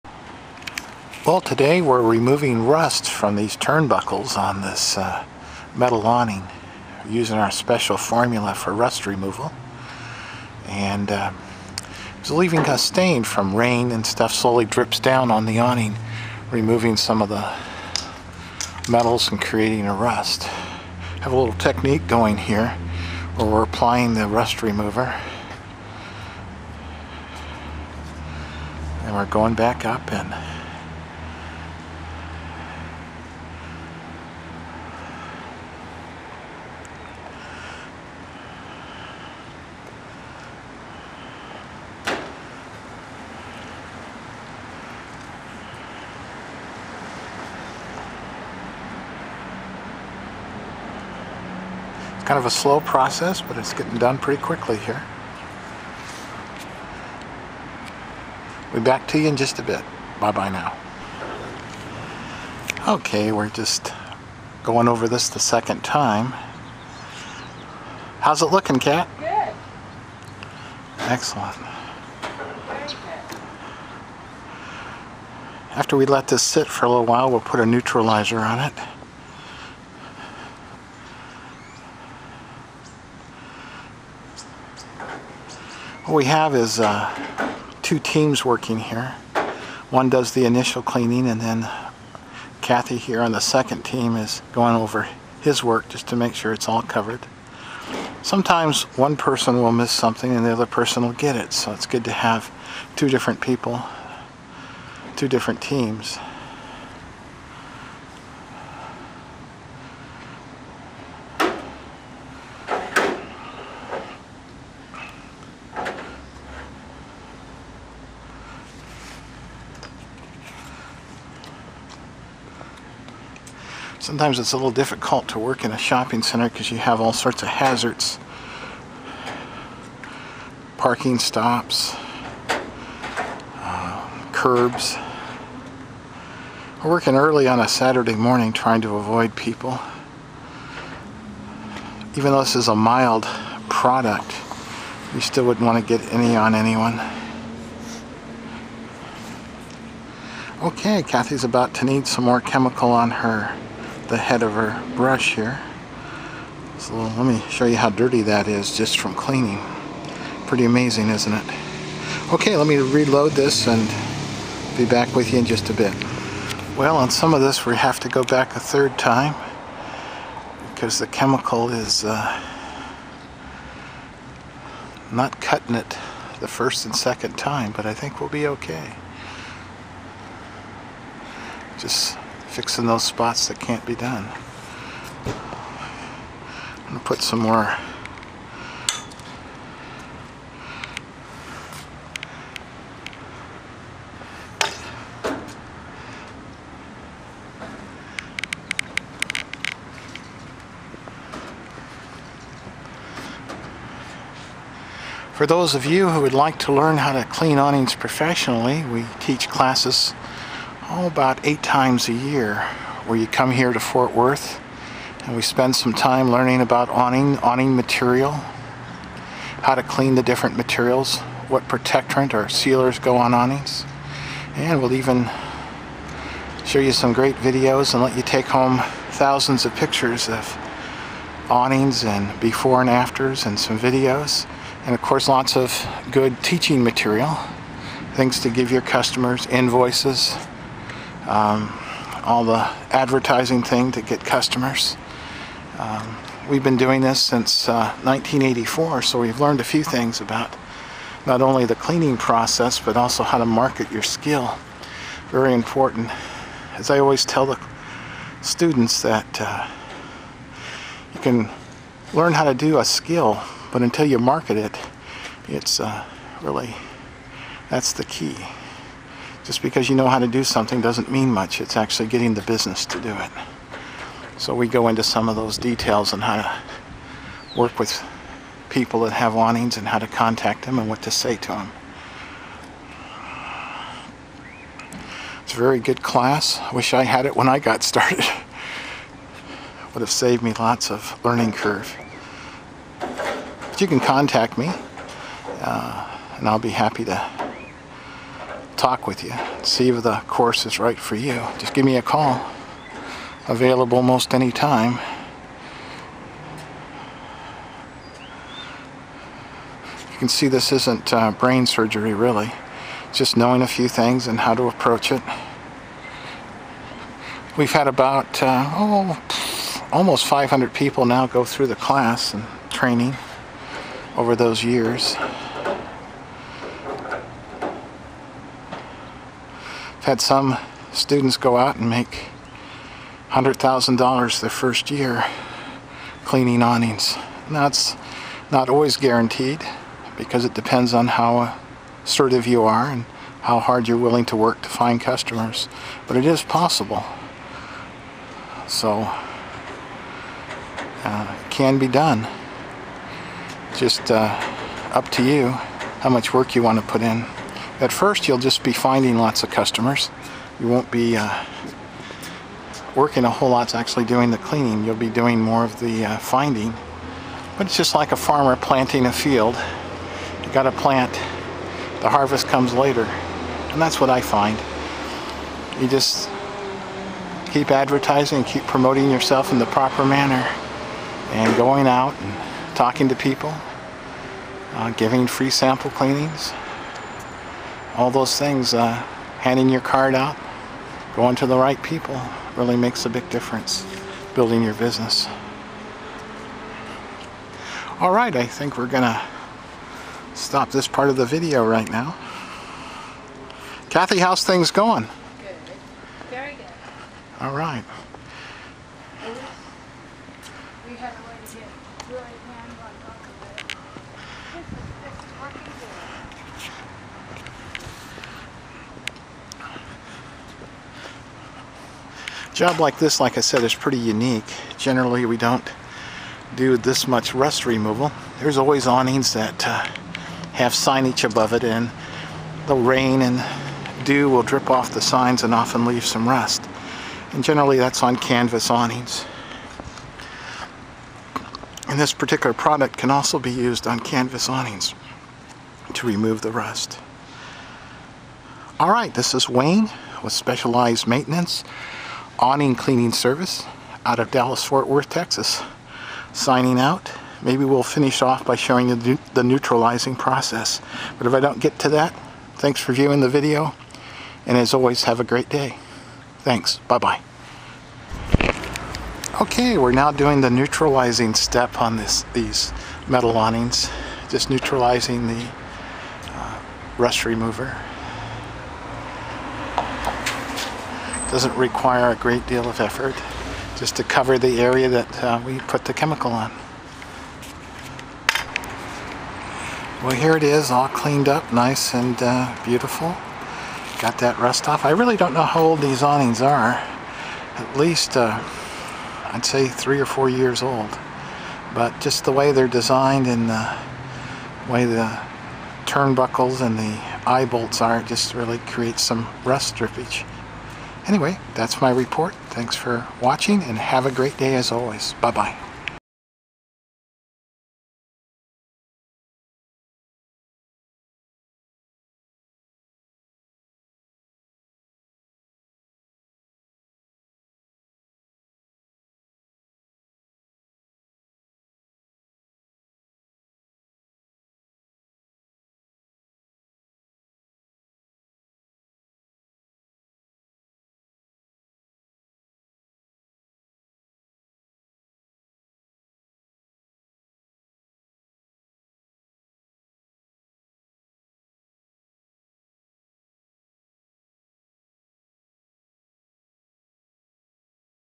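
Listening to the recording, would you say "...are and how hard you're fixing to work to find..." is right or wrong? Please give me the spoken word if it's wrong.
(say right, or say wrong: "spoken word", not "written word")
wrong: "willing", not "fixing".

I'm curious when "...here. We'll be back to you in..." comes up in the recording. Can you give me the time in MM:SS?
00:54.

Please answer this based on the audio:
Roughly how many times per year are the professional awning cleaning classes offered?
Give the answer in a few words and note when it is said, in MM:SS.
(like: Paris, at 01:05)
8, at 03:31.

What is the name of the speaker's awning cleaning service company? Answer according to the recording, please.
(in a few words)
Specialized Maintenance.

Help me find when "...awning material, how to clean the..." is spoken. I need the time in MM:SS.
03:37.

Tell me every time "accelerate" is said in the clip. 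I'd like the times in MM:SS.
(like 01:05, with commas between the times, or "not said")
not said.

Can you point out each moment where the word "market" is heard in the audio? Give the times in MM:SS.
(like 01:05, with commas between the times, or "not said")
04:13, 04:24.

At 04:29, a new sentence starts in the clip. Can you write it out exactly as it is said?
Just because you know how to do something doesn't mean much.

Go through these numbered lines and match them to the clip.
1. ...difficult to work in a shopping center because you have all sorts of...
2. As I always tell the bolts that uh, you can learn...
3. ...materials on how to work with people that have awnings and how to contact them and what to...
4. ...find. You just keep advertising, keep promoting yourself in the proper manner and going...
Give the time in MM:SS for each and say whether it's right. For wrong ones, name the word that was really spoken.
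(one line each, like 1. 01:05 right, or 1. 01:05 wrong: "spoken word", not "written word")
1. 02:04 right
2. 04:16 wrong: "students", not "bolts"
3. 04:35 wrong: "details", not "materials"
4. 06:14 right.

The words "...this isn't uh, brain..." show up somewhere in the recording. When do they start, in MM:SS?
05:10.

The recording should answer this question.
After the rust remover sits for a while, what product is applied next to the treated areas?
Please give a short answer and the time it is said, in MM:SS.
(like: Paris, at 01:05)
neutralizer, at 01:17.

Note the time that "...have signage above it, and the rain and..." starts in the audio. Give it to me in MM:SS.
07:10.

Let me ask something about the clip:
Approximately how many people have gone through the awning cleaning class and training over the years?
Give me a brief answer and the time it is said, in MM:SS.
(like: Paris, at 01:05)
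almost 500, at 05:19.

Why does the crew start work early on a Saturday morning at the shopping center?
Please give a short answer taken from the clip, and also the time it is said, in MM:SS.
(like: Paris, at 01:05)
to avoid people, at 02:18.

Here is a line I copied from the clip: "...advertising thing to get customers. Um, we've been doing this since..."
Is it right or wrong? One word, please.
right.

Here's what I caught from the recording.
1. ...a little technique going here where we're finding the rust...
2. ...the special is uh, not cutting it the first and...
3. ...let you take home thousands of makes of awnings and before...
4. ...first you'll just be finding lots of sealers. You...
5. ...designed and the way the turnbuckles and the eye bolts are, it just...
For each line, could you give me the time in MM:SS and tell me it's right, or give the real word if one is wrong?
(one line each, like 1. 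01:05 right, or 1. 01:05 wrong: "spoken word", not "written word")
1. 00:21 wrong: "applying", not "finding"
2. 02:50 wrong: "chemical", not "special"
3. 03:48 wrong: "pictures", not "makes"
4. 05:57 wrong: "customers", not "sealers"
5. 08:22 right.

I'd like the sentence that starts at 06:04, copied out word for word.
You'll be doing more of the uh, finding.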